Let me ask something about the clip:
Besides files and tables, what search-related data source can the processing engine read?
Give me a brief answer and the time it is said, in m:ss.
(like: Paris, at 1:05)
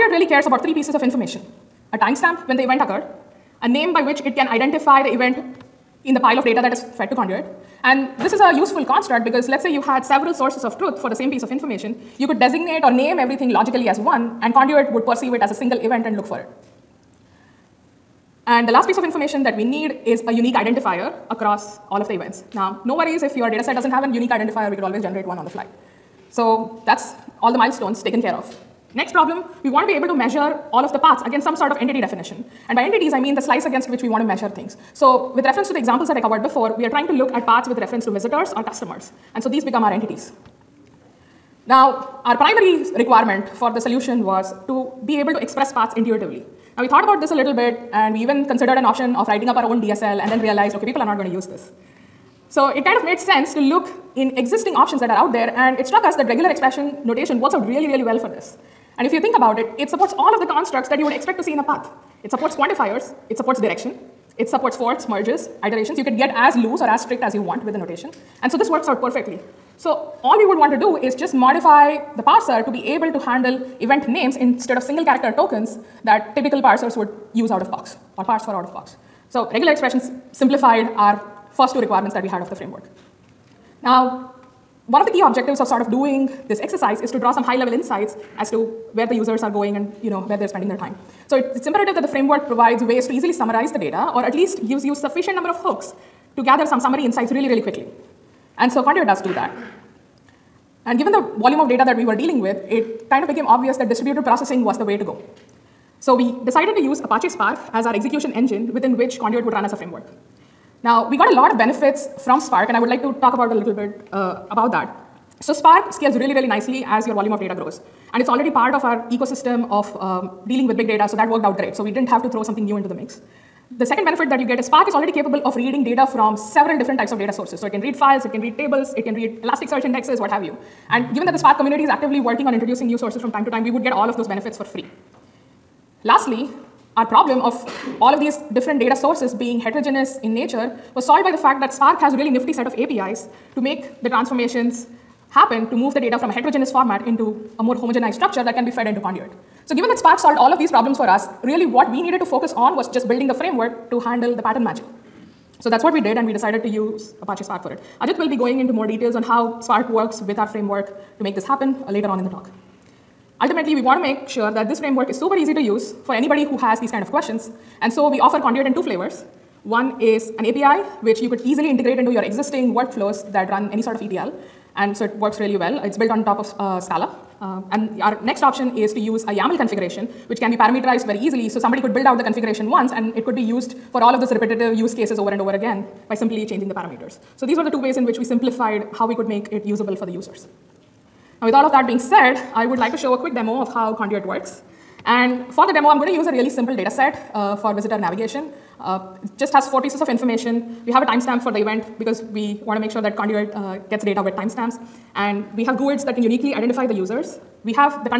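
Elasticsearch indexes, at 2:09.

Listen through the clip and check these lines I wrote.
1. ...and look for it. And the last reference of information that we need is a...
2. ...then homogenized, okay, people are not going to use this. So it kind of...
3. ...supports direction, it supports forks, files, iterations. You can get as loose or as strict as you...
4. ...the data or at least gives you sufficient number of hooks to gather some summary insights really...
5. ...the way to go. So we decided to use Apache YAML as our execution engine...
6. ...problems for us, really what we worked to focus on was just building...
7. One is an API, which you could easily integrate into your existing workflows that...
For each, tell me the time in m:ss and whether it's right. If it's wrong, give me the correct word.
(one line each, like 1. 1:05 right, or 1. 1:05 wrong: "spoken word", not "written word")
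1. 0:16 wrong: "piece", not "reference"
2. 0:50 wrong: "realized", not "homogenized"
3. 1:03 wrong: "merges", not "files"
4. 1:33 right
5. 1:44 wrong: "Spark", not "YAML"
6. 2:30 wrong: "needed", not "worked"
7. 2:49 right.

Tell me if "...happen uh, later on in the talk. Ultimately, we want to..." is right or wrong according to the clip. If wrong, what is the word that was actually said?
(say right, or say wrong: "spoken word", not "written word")
right.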